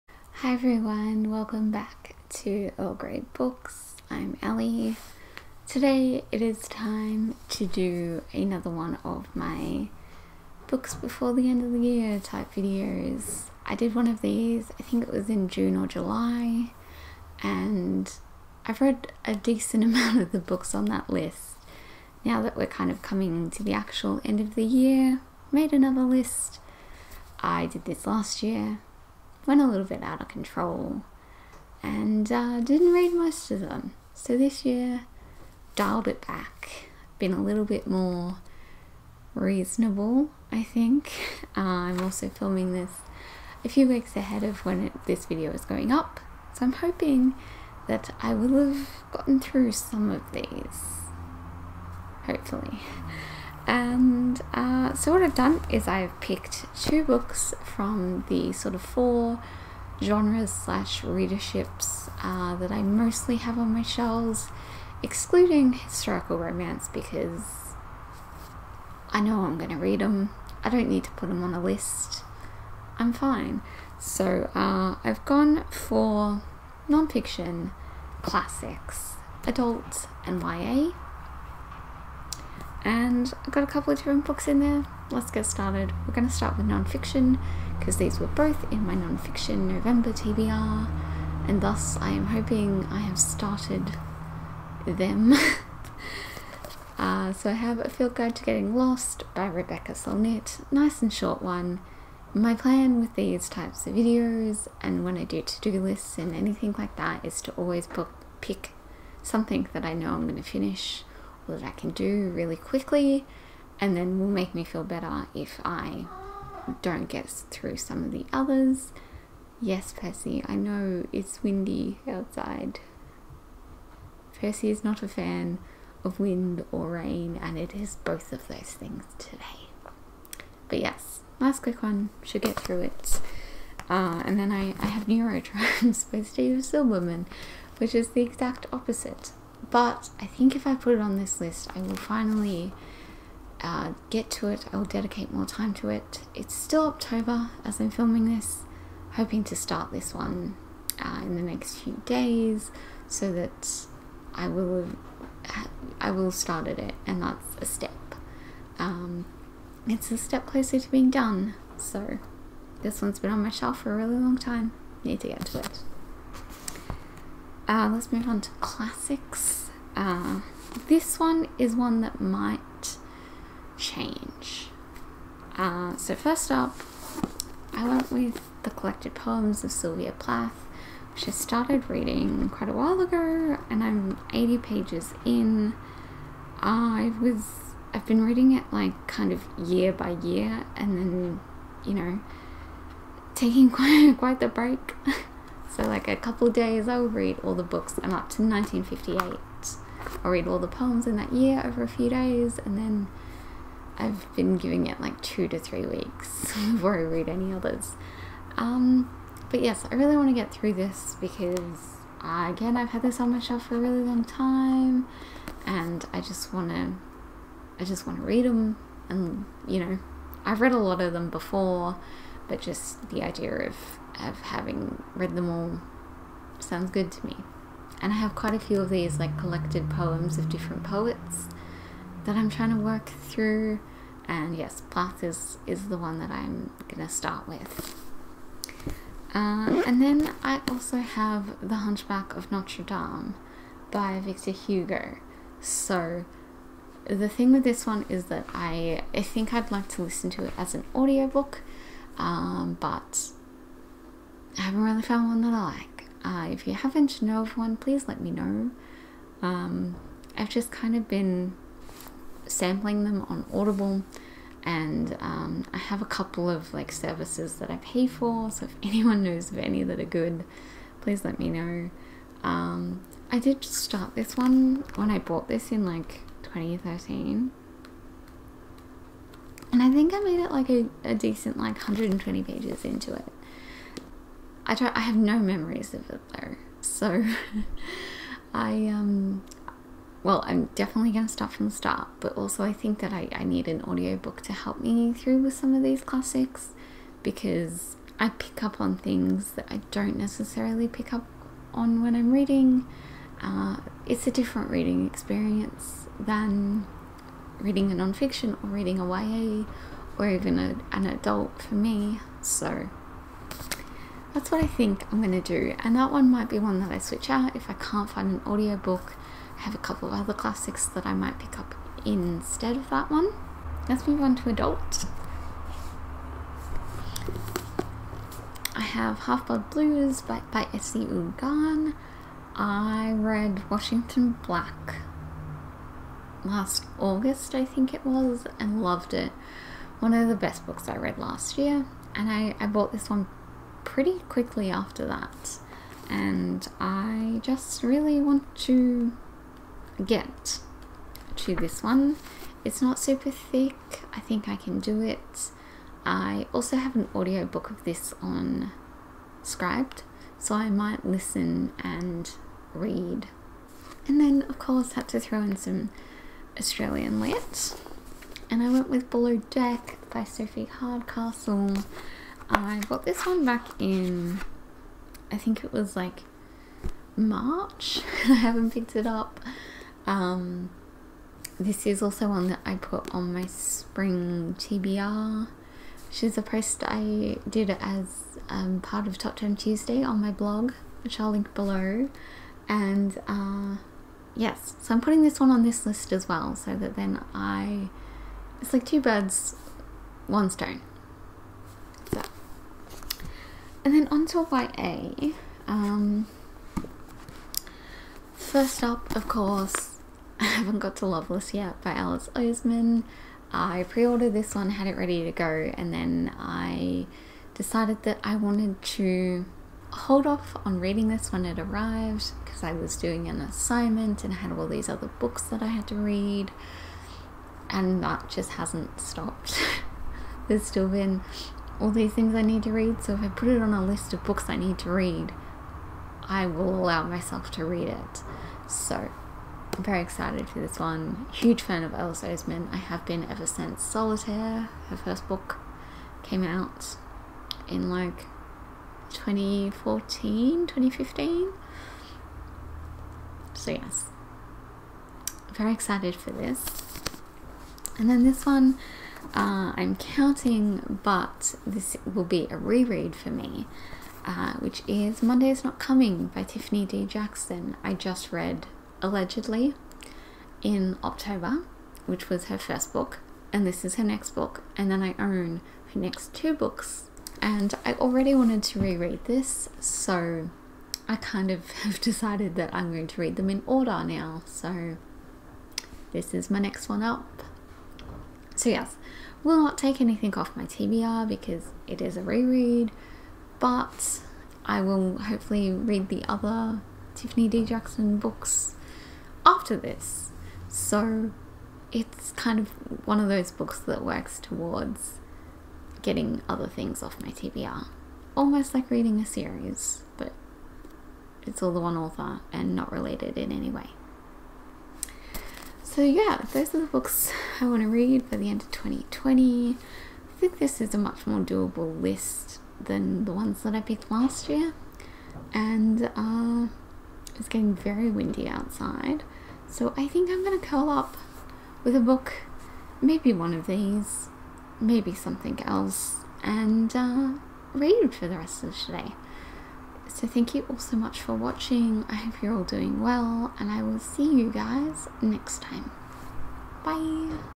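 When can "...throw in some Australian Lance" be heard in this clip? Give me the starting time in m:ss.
6:05.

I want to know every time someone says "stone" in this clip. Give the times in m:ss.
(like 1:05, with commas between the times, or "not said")
6:40.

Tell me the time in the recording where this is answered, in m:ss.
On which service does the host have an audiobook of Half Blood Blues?
5:59.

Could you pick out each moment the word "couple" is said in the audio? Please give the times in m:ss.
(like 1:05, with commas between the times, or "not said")
1:23, 3:16, 4:26, 5:19.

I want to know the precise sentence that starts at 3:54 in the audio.
And yes, Plath is, is the one that I'm going to start with.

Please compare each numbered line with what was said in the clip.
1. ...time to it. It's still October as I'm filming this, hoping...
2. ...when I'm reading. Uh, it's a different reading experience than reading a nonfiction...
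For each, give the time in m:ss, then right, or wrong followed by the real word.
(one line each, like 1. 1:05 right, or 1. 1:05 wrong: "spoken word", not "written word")
1. 2:25 right
2. 5:02 right.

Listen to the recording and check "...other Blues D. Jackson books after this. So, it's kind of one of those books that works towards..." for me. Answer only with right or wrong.
wrong.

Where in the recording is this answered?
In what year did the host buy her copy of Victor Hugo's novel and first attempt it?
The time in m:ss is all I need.
4:36.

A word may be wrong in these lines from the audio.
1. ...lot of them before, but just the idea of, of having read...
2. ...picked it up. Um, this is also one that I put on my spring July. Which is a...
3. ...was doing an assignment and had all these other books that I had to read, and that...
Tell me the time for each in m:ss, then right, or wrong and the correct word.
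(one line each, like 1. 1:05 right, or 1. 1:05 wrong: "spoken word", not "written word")
1. 3:40 right
2. 6:18 wrong: "TBR", not "July"
3. 7:02 right.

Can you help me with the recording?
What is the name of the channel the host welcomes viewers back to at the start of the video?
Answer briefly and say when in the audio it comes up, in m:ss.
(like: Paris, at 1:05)
Earl Grey Books, at 0:02.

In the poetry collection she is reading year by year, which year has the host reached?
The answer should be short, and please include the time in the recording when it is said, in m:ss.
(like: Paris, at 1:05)
1958, at 3:18.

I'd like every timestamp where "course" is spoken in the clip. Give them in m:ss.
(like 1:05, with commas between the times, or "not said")
6:04, 6:49.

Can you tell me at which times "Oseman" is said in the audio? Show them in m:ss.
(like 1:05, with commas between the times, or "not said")
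6:52, 7:22.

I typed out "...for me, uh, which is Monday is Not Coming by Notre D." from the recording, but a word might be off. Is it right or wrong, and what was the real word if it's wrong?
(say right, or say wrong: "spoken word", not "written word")
wrong: "Tiffany", not "Notre".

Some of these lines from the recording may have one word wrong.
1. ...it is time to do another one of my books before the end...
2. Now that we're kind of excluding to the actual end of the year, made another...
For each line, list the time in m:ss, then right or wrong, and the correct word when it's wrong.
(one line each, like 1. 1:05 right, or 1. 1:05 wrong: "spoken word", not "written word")
1. 0:06 right
2. 0:22 wrong: "coming", not "excluding".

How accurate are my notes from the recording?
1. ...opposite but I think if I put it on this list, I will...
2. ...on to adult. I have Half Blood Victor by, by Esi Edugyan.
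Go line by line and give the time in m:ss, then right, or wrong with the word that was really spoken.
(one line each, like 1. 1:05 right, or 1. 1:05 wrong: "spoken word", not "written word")
1. 2:18 right
2. 5:24 wrong: "Blues", not "Victor".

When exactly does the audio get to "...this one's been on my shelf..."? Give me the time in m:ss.
2:42.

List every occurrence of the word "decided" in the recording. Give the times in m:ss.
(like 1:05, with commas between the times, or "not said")
6:57, 8:01.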